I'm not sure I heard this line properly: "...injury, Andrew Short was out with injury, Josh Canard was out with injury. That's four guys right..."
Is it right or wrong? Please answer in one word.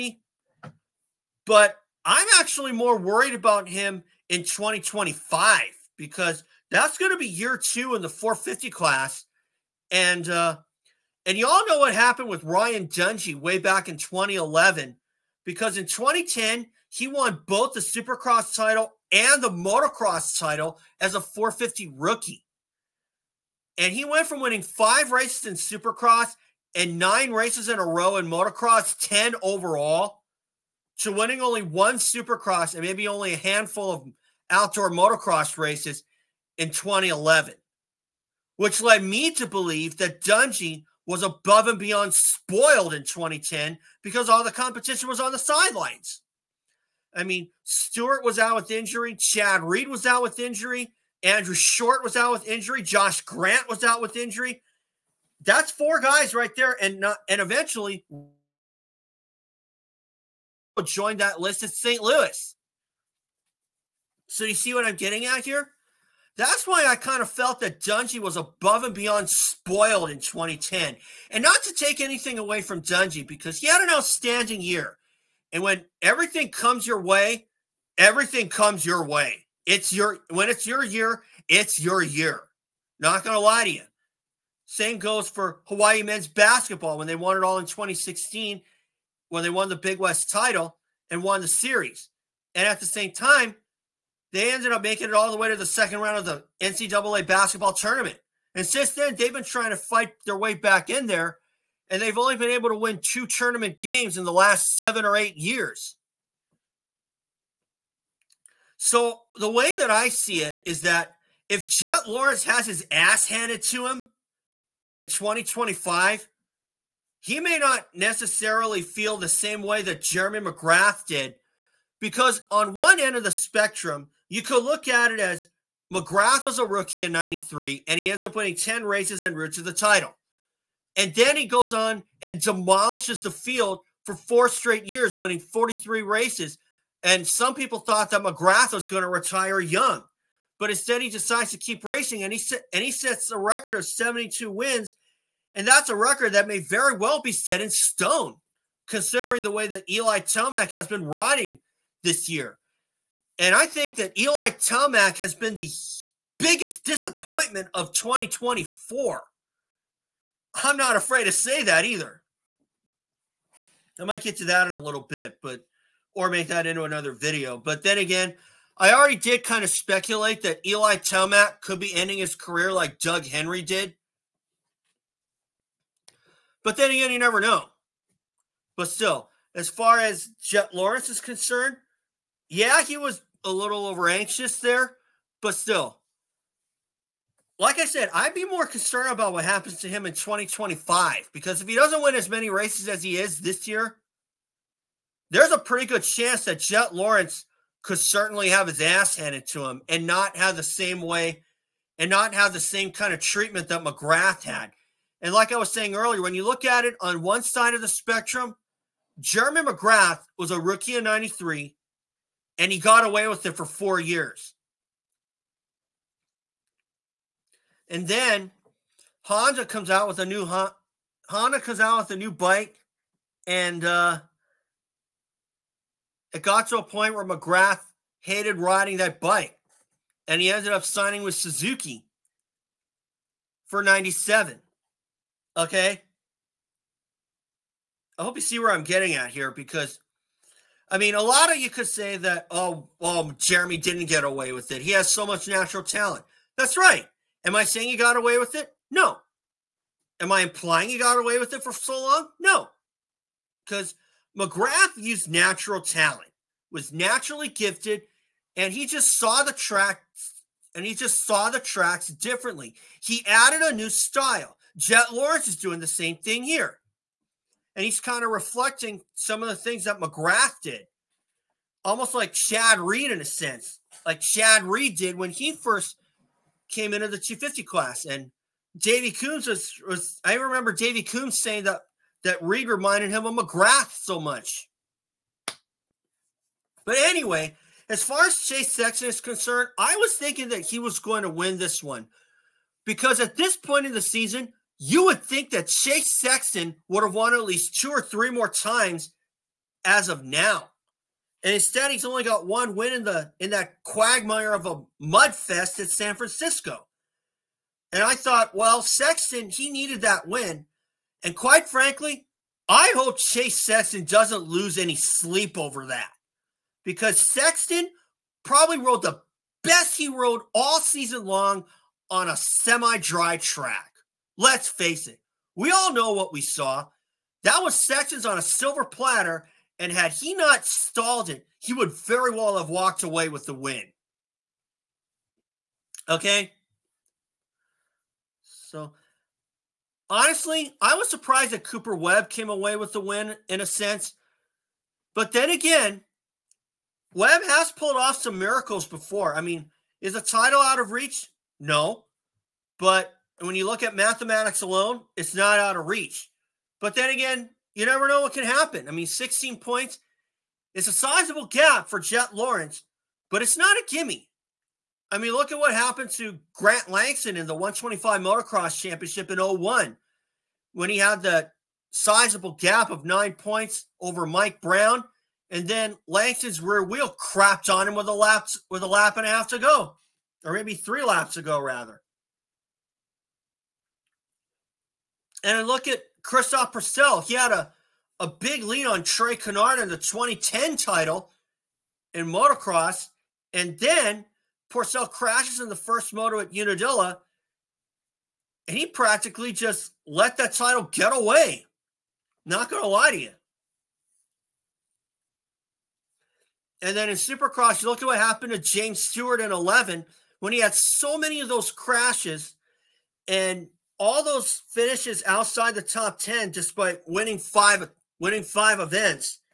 wrong.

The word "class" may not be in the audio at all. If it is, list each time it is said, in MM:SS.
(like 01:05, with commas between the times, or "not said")
00:08, 04:37.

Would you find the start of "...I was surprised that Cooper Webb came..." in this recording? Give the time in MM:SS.
05:40.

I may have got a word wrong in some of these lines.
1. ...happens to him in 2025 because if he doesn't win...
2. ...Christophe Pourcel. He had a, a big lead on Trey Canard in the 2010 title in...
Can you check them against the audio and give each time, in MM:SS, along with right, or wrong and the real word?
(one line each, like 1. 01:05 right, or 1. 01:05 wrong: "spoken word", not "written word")
1. 03:09 right
2. 06:26 right.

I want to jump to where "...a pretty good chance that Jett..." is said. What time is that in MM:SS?
03:15.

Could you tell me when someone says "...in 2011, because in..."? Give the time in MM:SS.
00:13.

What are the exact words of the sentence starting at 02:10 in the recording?
And then he goes on and demolishes the field for four straight years, winning 43 races.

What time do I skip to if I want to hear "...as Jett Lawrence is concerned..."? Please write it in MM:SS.
02:59.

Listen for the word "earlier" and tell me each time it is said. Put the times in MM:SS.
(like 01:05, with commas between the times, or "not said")
03:25.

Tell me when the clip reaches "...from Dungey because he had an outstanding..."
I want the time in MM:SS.
01:12.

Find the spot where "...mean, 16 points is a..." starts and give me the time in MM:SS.
05:58.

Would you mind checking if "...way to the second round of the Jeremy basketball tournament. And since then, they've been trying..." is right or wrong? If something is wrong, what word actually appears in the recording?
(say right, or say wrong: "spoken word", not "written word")
wrong: "NCAA", not "Jeremy".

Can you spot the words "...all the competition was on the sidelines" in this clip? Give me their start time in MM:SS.
00:44.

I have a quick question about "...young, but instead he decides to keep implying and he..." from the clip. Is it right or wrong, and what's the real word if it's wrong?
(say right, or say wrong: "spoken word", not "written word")
wrong: "racing", not "implying".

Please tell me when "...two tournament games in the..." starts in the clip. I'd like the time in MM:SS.
01:43.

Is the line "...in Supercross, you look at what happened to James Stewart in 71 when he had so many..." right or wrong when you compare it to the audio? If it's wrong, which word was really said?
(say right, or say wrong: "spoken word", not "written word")
wrong: "11", not "71".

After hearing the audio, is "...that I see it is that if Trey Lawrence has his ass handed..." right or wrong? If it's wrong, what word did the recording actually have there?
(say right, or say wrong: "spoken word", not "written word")
wrong: "Jett", not "Trey".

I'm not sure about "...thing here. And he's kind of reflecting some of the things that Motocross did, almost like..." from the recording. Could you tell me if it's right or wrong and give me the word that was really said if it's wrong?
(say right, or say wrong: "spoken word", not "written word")
wrong: "McGrath", not "Motocross".